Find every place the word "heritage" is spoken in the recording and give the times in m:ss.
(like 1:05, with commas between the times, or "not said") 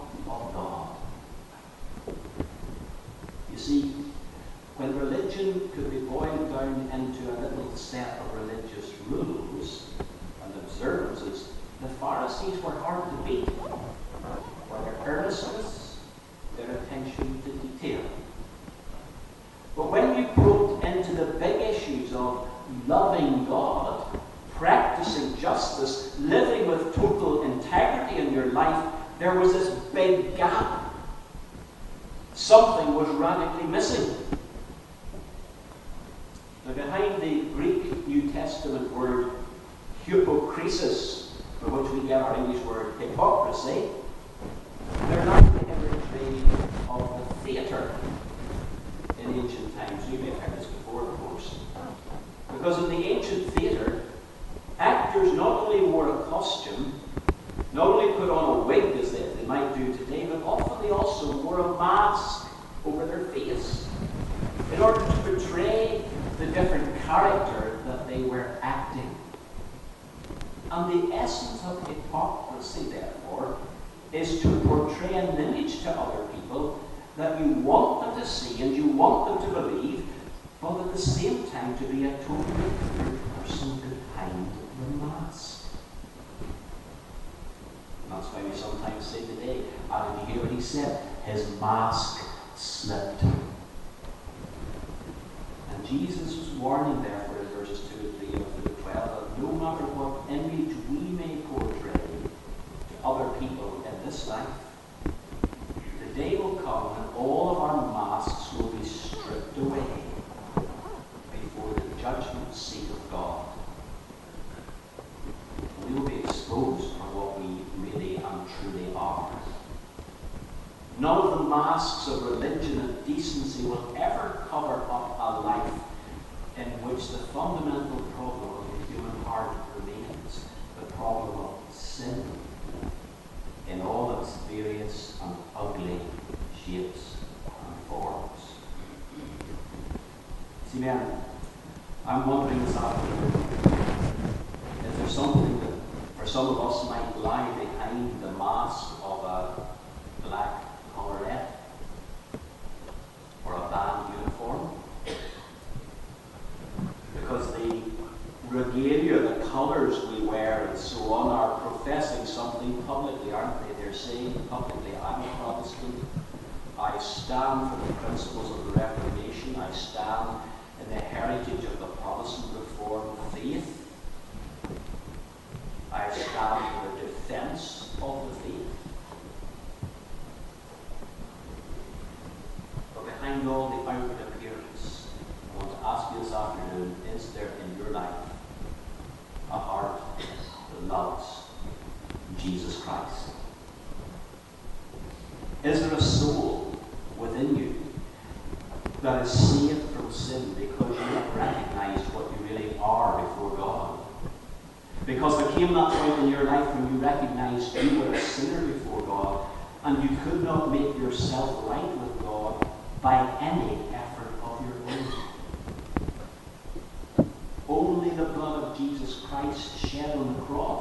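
2:51.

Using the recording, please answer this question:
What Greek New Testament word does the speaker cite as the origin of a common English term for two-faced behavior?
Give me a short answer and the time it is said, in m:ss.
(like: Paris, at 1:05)
hypocrisis, at 0:40.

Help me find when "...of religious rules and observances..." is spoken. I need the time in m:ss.
0:08.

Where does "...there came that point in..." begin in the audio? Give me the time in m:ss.
3:25.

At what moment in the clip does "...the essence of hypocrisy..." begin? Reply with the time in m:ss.
1:11.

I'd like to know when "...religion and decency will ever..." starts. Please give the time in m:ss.
2:02.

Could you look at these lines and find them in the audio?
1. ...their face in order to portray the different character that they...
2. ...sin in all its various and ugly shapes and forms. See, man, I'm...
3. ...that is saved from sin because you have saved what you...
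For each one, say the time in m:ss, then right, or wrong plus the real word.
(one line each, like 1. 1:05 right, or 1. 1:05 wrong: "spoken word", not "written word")
1. 1:03 right
2. 2:11 right
3. 3:19 wrong: "recognized", not "saved".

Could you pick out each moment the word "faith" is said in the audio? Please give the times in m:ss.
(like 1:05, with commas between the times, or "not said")
2:53, 2:58.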